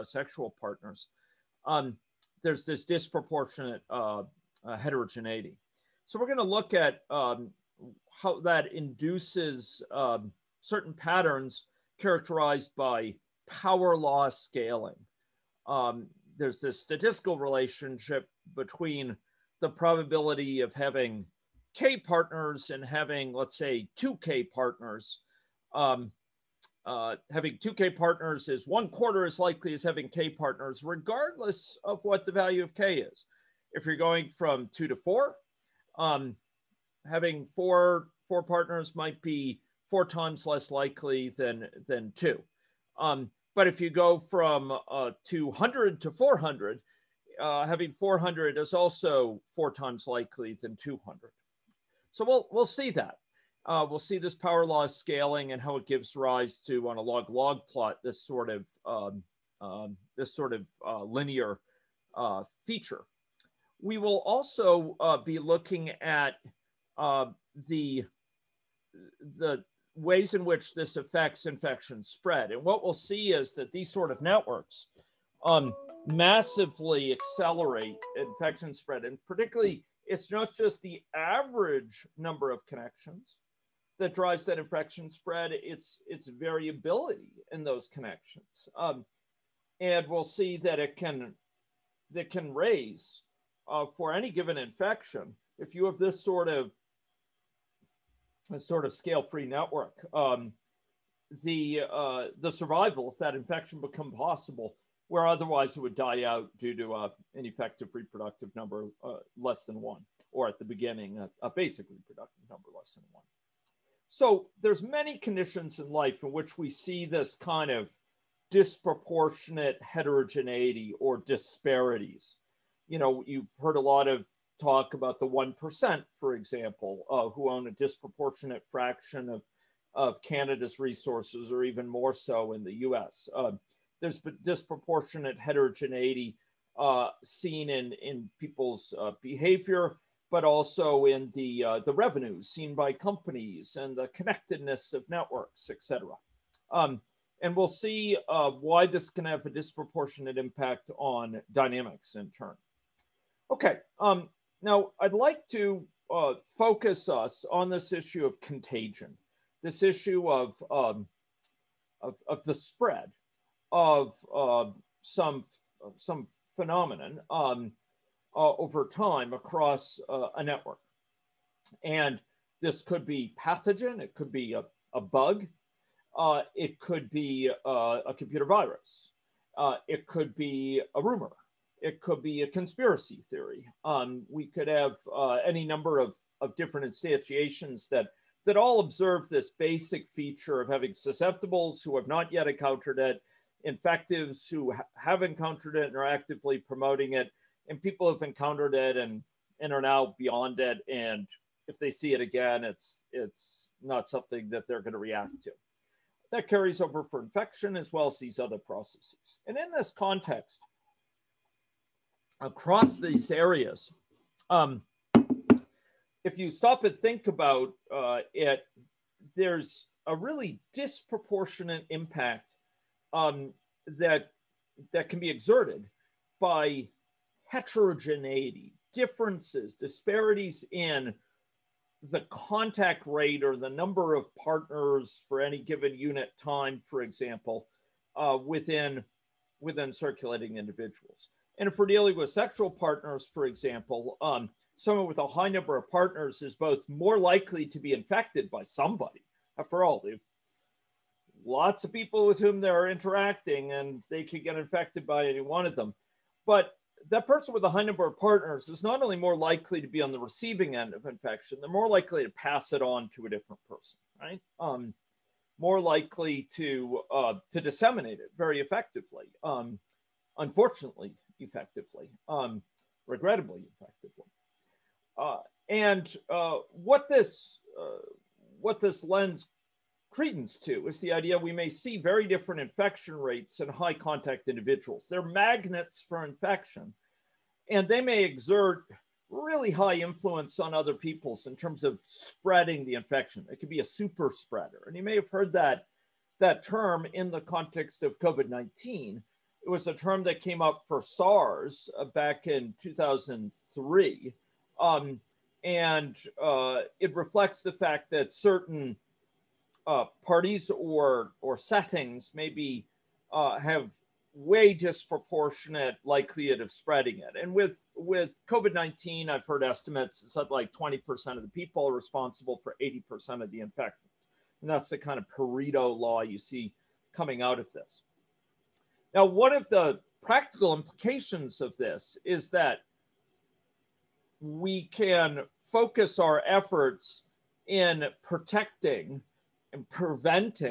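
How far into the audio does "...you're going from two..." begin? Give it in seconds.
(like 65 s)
33 s.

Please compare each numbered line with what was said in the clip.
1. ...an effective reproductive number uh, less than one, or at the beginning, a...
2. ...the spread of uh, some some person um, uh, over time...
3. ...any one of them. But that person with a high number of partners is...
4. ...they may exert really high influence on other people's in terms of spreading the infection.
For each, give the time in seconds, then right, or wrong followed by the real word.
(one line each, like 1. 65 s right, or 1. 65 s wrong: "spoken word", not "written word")
1. 107 s right
2. 162 s wrong: "phenomenon", not "person"
3. 255 s right
4. 287 s right.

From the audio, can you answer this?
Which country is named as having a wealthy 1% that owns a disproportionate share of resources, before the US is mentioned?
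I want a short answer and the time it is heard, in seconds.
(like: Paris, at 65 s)
Canada, at 130 s.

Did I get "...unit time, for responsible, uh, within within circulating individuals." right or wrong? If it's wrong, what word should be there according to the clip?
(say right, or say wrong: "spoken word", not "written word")
wrong: "example", not "responsible".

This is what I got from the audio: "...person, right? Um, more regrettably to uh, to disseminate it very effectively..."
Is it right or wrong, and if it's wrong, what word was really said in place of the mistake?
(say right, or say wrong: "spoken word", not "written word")
wrong: "likely", not "regrettably".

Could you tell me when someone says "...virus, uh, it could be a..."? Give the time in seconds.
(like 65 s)
178 s.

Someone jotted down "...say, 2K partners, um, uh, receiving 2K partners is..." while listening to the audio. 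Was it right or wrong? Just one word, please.
wrong.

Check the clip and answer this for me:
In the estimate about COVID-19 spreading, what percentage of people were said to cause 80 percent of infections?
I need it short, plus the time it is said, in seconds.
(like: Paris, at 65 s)
20%, at 320 s.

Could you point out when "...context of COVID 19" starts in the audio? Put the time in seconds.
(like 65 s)
297 s.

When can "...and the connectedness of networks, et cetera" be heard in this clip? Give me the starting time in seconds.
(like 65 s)
143 s.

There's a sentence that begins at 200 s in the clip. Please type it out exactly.
And if they see it again, it's it's not something that they're going to react to.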